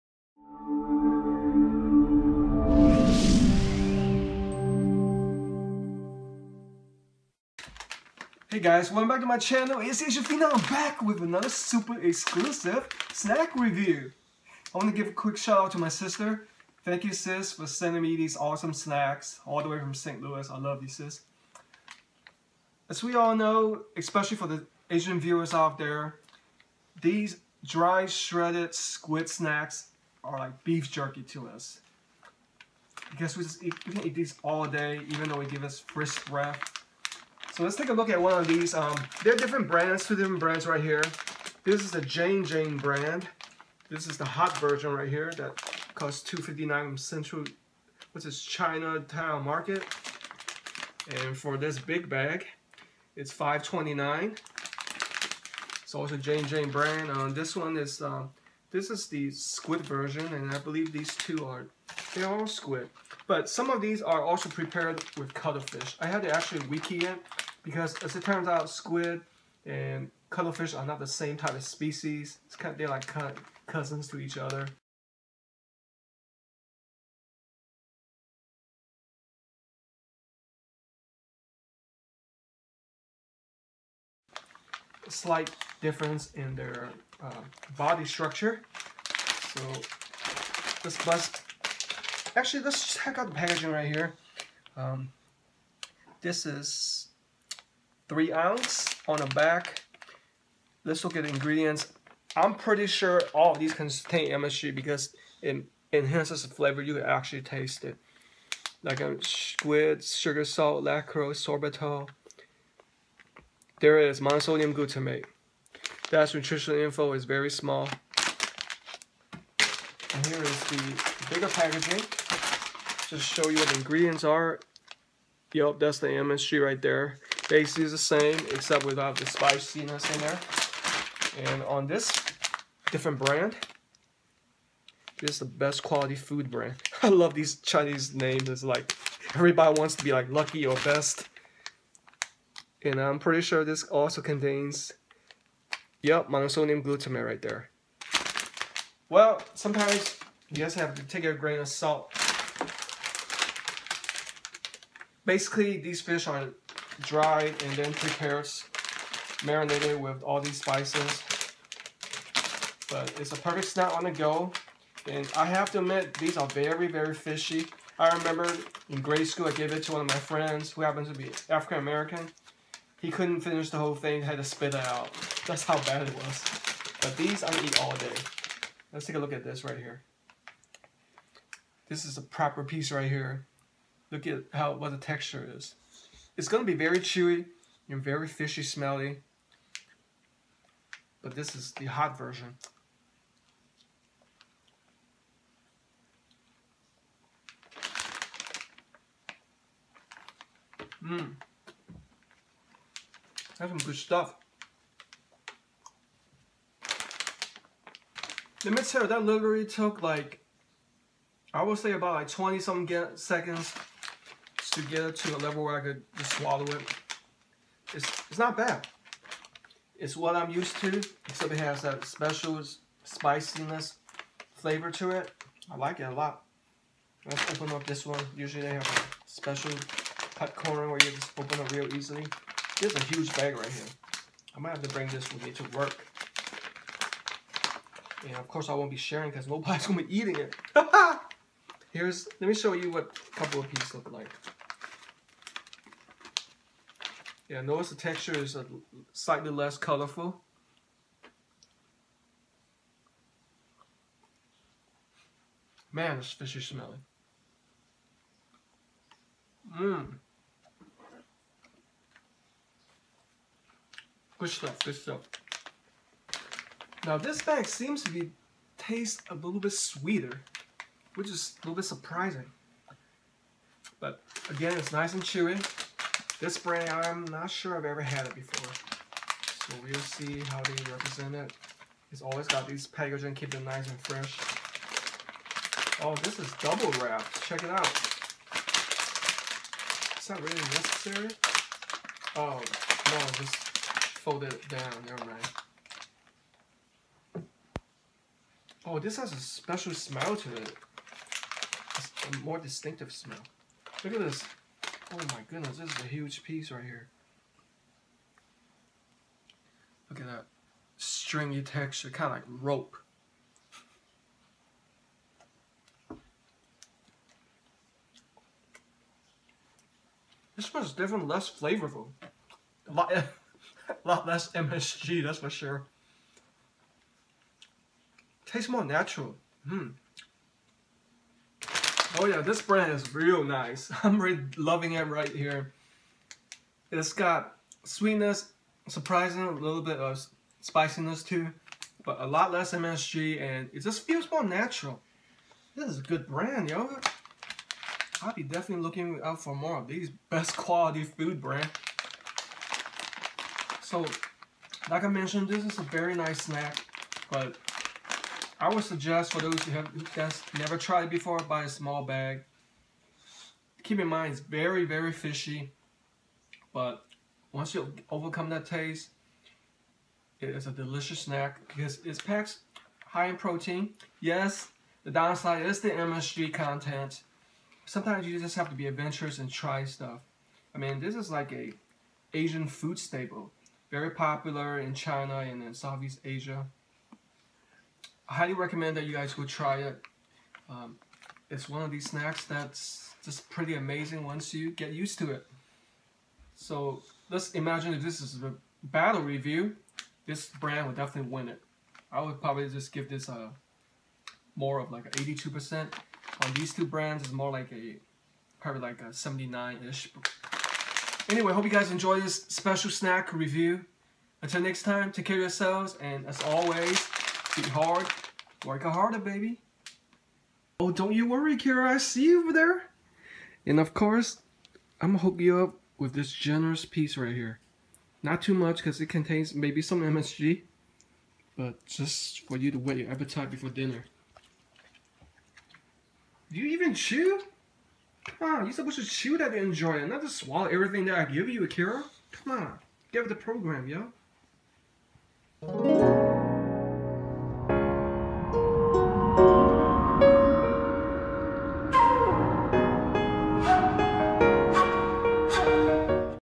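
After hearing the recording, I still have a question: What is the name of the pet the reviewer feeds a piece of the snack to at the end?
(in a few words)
Akira.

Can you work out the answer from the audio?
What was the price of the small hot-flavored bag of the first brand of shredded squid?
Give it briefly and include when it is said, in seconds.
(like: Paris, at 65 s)
2.59, at 46 s.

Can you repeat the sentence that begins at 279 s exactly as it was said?
So we'll see how they represent it.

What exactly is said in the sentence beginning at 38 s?
Um, there are different brands, two different brands right here.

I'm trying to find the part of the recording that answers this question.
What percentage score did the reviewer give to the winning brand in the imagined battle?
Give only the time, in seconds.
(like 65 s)
405 s.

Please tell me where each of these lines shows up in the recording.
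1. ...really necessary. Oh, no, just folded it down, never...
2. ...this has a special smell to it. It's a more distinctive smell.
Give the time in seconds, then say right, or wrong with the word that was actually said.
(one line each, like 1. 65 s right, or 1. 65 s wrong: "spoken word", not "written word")
1. 290 s right
2. 298 s right.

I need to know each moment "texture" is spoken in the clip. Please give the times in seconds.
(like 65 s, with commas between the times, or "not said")
184 s, 247 s, 311 s.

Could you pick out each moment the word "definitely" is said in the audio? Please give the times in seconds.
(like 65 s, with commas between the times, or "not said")
348 s, 400 s.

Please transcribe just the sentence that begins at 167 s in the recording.
I remember in grade school, I gave it to one of my friends who happened to be African American.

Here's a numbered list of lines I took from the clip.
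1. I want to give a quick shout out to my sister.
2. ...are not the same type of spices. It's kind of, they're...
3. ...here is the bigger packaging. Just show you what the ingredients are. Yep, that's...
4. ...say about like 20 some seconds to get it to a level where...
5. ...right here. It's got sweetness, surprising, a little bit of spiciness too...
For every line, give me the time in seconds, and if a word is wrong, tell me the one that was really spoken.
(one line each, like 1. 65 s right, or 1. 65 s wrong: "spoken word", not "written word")
1. 14 s right
2. 70 s wrong: "species", not "spices"
3. 120 s right
4. 211 s right
5. 335 s right.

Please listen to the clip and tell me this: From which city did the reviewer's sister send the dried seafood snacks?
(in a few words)
St. Louis.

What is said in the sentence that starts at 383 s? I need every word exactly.
Very popular in China and in Southeast Asia.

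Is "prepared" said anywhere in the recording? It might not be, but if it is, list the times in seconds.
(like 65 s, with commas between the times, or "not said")
64 s, 157 s.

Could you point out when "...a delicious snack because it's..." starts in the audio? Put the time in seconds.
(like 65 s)
370 s.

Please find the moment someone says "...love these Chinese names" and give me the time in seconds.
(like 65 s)
137 s.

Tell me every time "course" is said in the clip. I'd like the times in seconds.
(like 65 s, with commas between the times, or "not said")
238 s, 423 s.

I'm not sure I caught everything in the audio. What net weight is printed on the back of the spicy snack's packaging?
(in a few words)
3 ounces.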